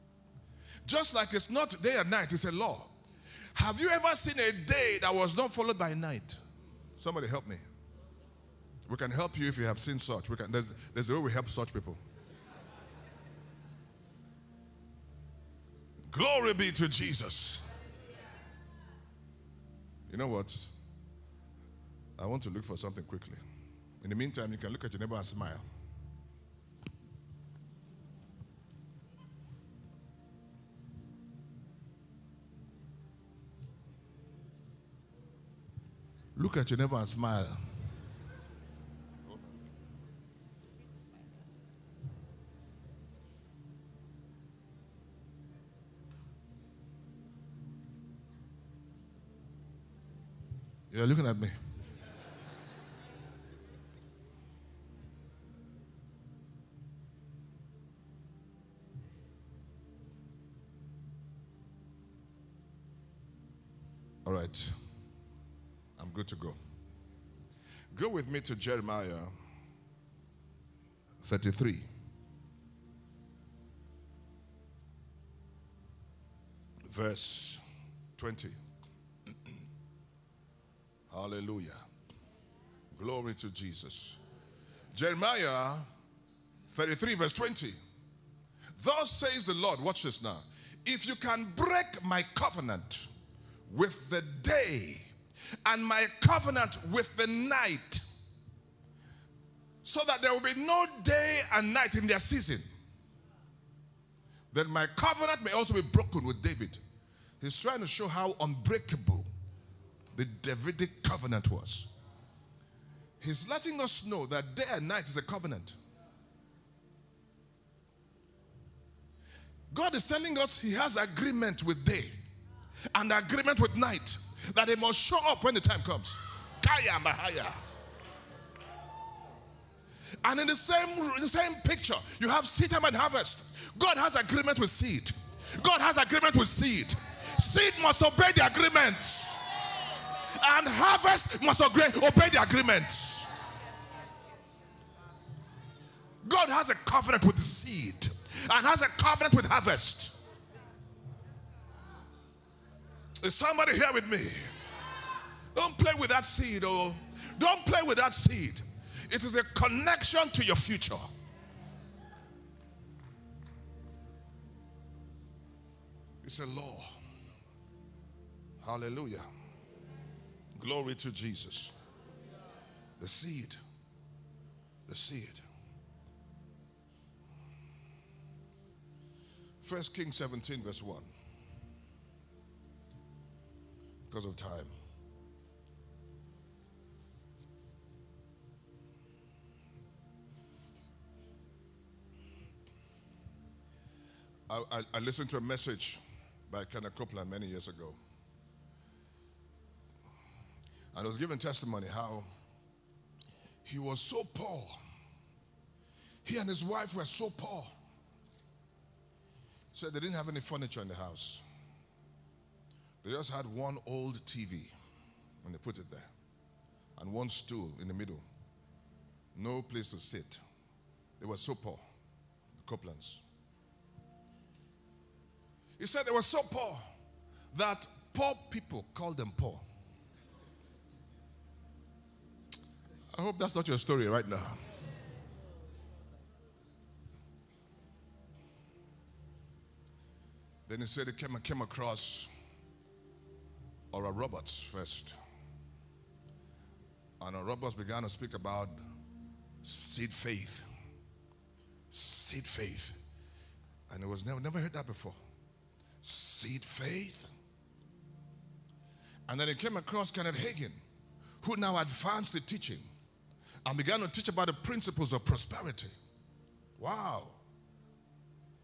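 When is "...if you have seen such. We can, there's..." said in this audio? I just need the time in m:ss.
0:09.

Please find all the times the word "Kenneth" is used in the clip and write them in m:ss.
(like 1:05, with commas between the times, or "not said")
3:16, 4:20.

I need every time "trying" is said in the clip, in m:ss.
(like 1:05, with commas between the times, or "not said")
1:47.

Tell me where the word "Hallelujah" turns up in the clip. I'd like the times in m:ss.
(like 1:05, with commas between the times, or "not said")
1:21, 2:48.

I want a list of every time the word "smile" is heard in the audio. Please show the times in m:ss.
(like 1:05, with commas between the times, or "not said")
0:25, 0:37.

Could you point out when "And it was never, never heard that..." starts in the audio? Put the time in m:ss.
4:13.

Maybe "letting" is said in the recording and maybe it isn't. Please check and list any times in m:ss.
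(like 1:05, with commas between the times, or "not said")
1:53.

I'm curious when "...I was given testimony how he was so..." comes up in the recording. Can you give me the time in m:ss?
3:21.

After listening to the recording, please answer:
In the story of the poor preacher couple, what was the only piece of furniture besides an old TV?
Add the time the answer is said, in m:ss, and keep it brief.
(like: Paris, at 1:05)
One stool, at 3:37.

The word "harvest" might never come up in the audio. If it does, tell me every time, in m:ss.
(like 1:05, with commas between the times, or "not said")
2:12, 2:20, 2:29.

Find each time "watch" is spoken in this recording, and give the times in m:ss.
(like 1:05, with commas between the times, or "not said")
1:29.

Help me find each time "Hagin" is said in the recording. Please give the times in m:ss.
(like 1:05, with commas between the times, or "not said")
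4:20.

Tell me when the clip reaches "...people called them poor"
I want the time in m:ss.
3:48.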